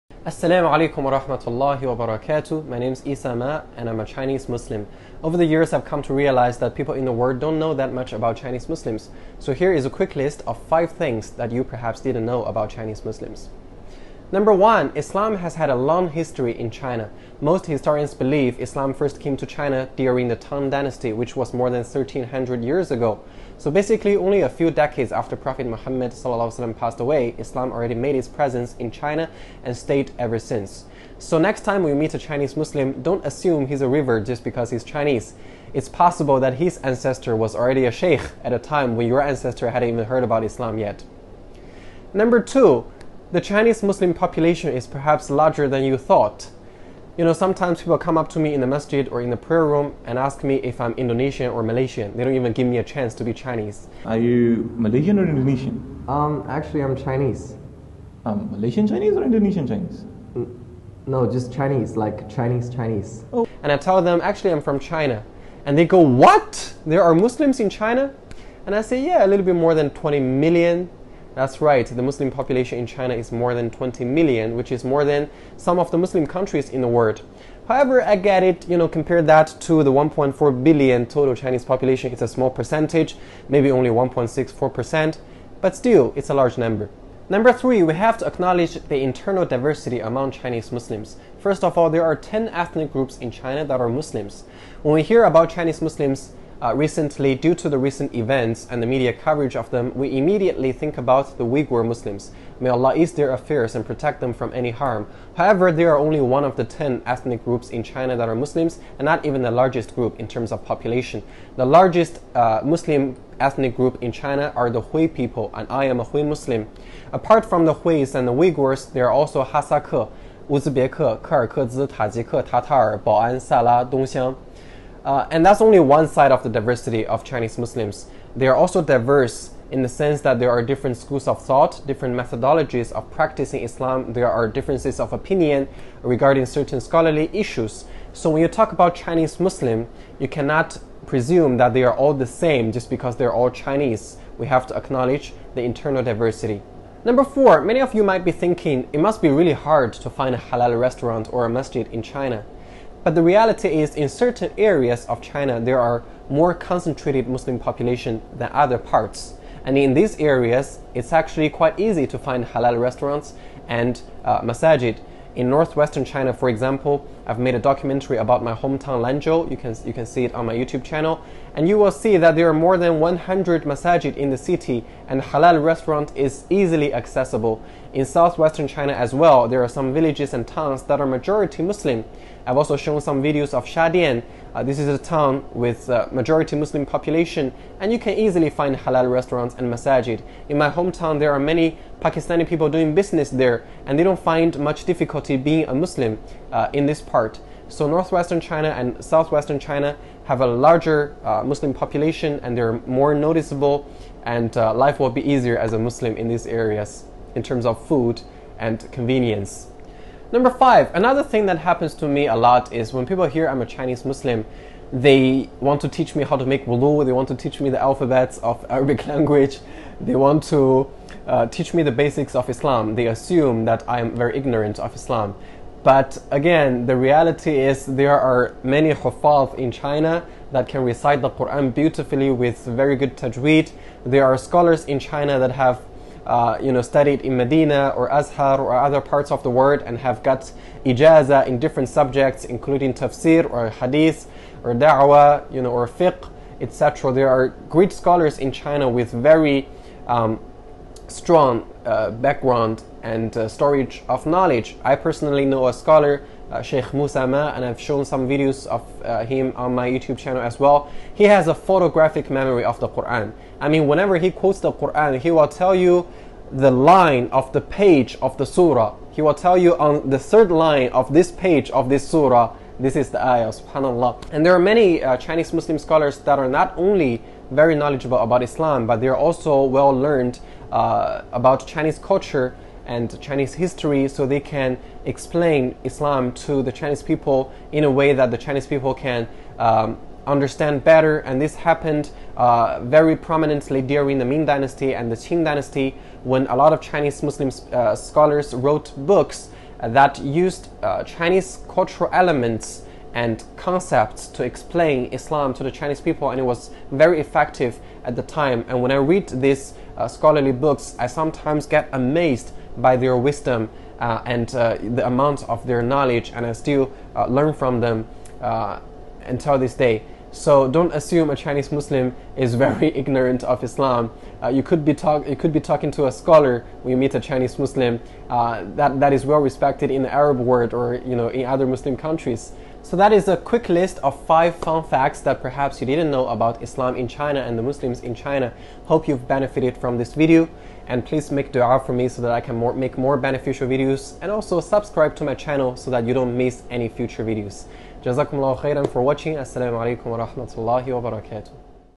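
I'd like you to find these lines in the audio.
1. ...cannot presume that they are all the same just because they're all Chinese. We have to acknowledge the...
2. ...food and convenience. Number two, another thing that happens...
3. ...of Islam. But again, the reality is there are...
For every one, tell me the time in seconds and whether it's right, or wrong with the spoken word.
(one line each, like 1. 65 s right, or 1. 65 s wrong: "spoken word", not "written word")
1. 140 s right
2. 207 s wrong: "five", not "two"
3. 224 s right.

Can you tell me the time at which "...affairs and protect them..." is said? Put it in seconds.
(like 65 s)
103 s.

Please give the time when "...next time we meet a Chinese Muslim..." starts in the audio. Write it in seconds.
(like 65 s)
31 s.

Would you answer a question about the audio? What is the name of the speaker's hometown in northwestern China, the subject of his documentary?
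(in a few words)
Lanzhou.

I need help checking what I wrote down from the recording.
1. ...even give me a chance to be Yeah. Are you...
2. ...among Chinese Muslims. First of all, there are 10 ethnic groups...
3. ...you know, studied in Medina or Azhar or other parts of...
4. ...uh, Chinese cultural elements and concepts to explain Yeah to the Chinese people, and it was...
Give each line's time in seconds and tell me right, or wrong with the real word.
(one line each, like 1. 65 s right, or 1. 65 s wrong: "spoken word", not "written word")
1. 52 s wrong: "Chinese", not "Yeah"
2. 90 s right
3. 236 s right
4. 300 s wrong: "Islam", not "Yeah".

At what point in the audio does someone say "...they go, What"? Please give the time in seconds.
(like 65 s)
65 s.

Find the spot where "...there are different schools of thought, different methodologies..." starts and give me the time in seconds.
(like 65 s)
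130 s.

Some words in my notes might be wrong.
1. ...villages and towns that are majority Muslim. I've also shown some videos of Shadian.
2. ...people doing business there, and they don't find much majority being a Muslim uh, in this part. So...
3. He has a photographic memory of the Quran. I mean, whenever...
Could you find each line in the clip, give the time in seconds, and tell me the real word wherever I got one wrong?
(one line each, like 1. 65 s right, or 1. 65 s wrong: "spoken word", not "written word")
1. 179 s right
2. 192 s wrong: "difficulty", not "majority"
3. 261 s right.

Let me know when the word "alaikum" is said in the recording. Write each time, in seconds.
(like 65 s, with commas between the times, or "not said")
0 s, 349 s.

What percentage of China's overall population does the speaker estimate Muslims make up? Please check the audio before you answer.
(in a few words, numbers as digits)
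1.64%.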